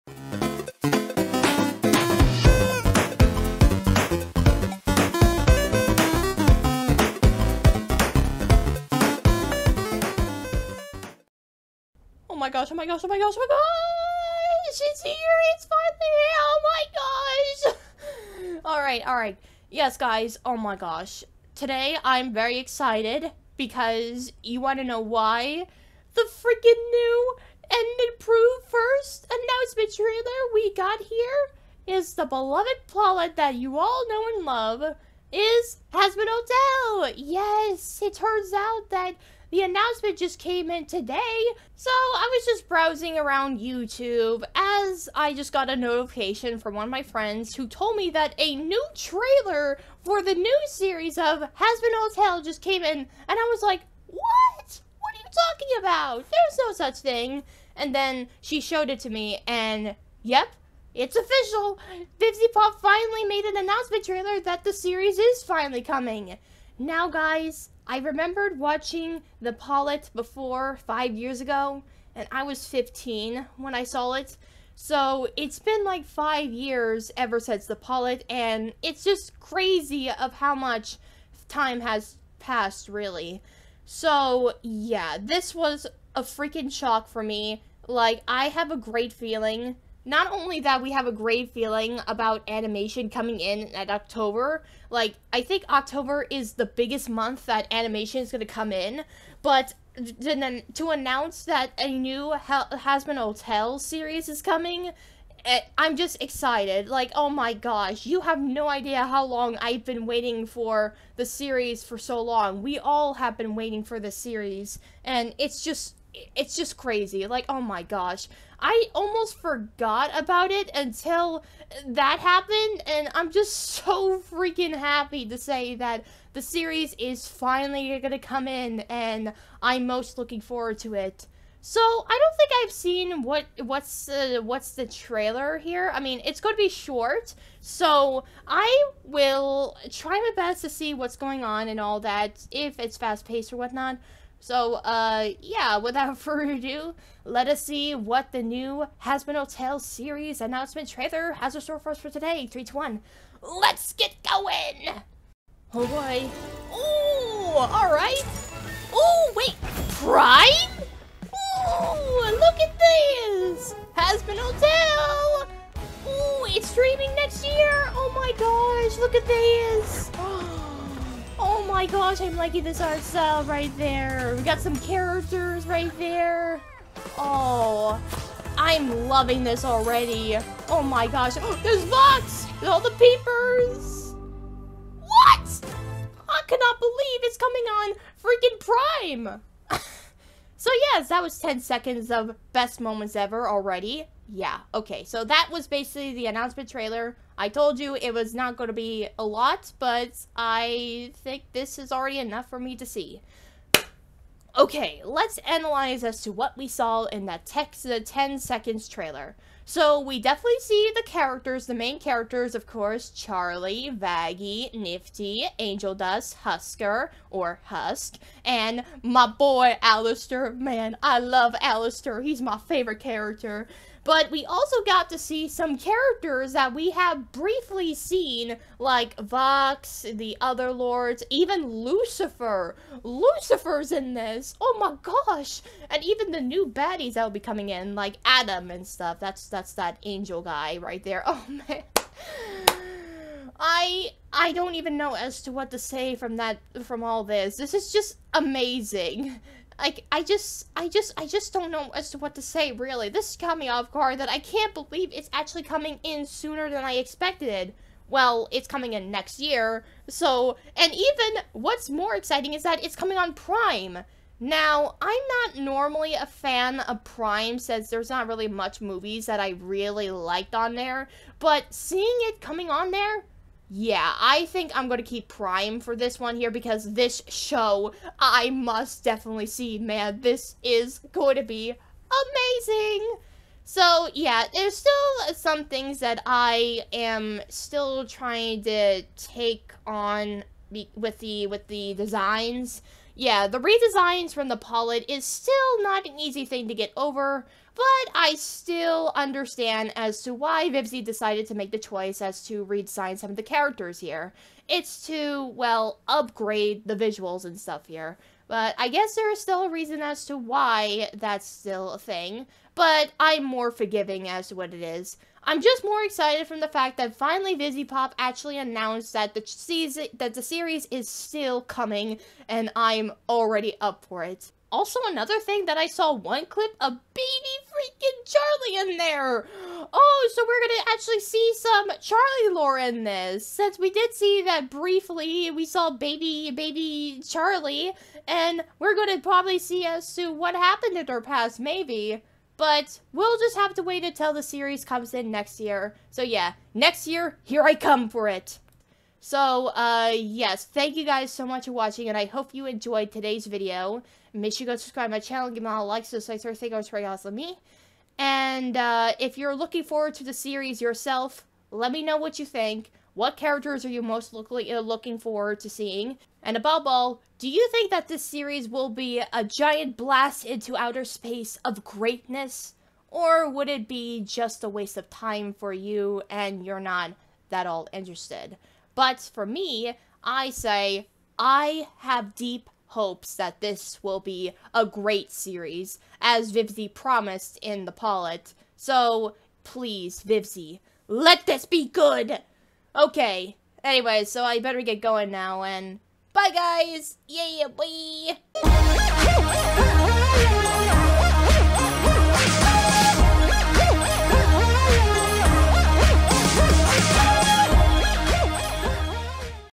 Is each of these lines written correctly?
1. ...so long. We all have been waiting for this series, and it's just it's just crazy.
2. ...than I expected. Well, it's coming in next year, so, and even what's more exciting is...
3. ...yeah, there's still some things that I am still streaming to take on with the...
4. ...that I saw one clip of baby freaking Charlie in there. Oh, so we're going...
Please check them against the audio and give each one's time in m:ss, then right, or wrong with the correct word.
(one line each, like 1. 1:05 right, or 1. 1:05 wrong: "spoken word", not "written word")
1. 1:51 right
2. 4:16 right
3. 4:44 wrong: "trying", not "streaming"
4. 5:25 right.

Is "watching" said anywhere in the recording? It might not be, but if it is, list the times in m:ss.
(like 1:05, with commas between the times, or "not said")
1:08, 5:51.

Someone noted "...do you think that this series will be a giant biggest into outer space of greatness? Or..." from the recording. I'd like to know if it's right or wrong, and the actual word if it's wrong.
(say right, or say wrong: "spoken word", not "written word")
wrong: "blast", not "biggest".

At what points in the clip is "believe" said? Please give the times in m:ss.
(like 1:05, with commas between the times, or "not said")
3:06, 4:14.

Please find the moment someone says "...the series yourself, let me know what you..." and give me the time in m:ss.
6:00.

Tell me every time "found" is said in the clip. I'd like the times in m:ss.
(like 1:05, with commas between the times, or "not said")
not said.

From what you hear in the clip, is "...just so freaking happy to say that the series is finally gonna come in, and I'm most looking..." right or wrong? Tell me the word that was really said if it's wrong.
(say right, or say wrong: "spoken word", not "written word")
right.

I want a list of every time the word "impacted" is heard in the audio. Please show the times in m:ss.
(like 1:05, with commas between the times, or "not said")
not said.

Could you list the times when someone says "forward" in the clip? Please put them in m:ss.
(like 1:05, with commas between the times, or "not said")
2:10, 5:59, 6:05.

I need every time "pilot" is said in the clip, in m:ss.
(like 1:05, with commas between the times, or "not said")
1:09, 1:17, 4:54, 6:27.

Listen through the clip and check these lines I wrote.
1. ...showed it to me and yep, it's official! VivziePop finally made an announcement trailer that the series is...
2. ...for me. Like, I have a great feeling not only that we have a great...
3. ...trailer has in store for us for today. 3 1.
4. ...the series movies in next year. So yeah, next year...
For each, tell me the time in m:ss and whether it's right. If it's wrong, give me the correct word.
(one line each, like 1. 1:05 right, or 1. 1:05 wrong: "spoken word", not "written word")
1. 0:58 right
2. 1:27 right
3. 2:30 right
4. 5:44 wrong: "comes", not "movies".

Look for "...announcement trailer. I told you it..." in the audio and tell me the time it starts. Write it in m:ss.
3:16.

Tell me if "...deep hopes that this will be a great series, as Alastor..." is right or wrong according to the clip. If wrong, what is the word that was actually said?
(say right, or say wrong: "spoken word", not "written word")
wrong: "Vivzie", not "Alastor".